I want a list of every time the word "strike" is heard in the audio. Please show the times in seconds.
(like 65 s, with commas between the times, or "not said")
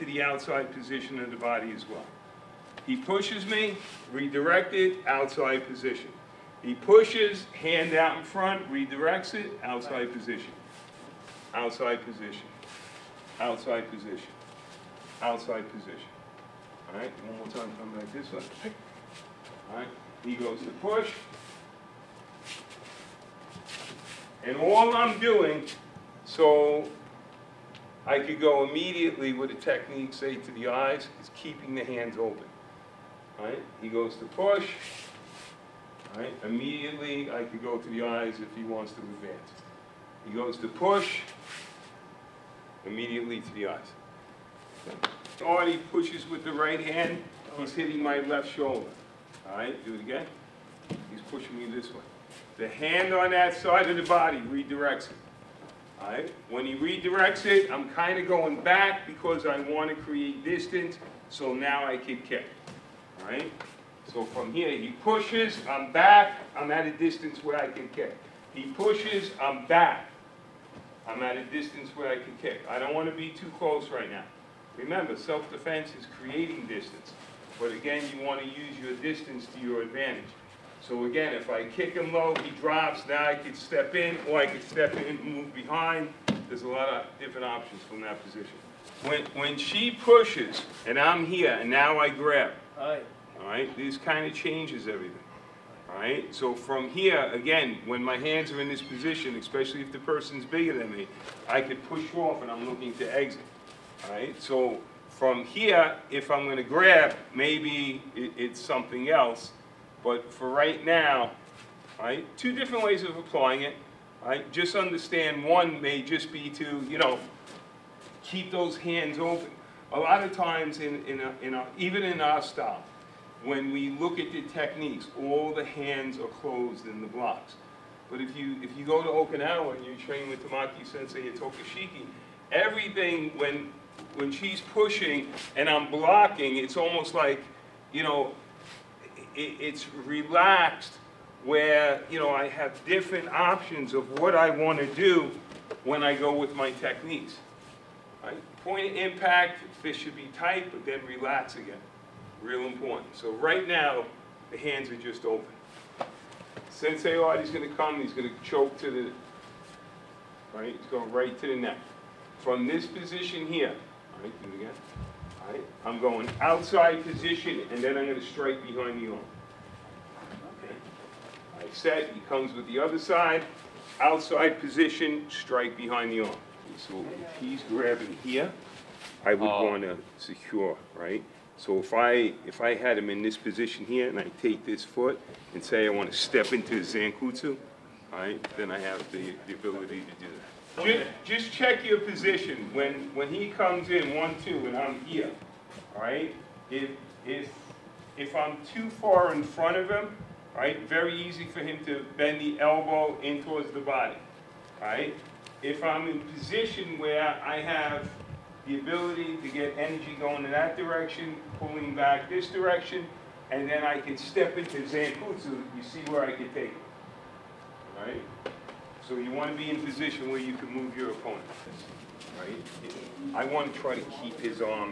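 168 s, 175 s.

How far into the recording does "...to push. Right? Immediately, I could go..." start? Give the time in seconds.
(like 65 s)
34 s.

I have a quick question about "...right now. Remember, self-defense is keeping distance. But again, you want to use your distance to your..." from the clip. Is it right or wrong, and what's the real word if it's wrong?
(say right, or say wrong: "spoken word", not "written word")
wrong: "creating", not "keeping".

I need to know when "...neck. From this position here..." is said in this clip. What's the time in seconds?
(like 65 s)
161 s.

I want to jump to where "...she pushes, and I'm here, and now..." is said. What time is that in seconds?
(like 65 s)
89 s.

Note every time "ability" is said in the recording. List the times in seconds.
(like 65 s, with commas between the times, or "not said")
189 s, 208 s.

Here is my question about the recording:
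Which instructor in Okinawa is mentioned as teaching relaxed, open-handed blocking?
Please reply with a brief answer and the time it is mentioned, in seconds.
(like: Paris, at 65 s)
Tamaki Sensei, at 130 s.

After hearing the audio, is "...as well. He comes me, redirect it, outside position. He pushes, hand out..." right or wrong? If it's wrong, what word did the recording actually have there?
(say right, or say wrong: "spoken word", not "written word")
wrong: "pushes", not "comes".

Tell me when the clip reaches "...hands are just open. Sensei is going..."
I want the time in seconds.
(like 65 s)
154 s.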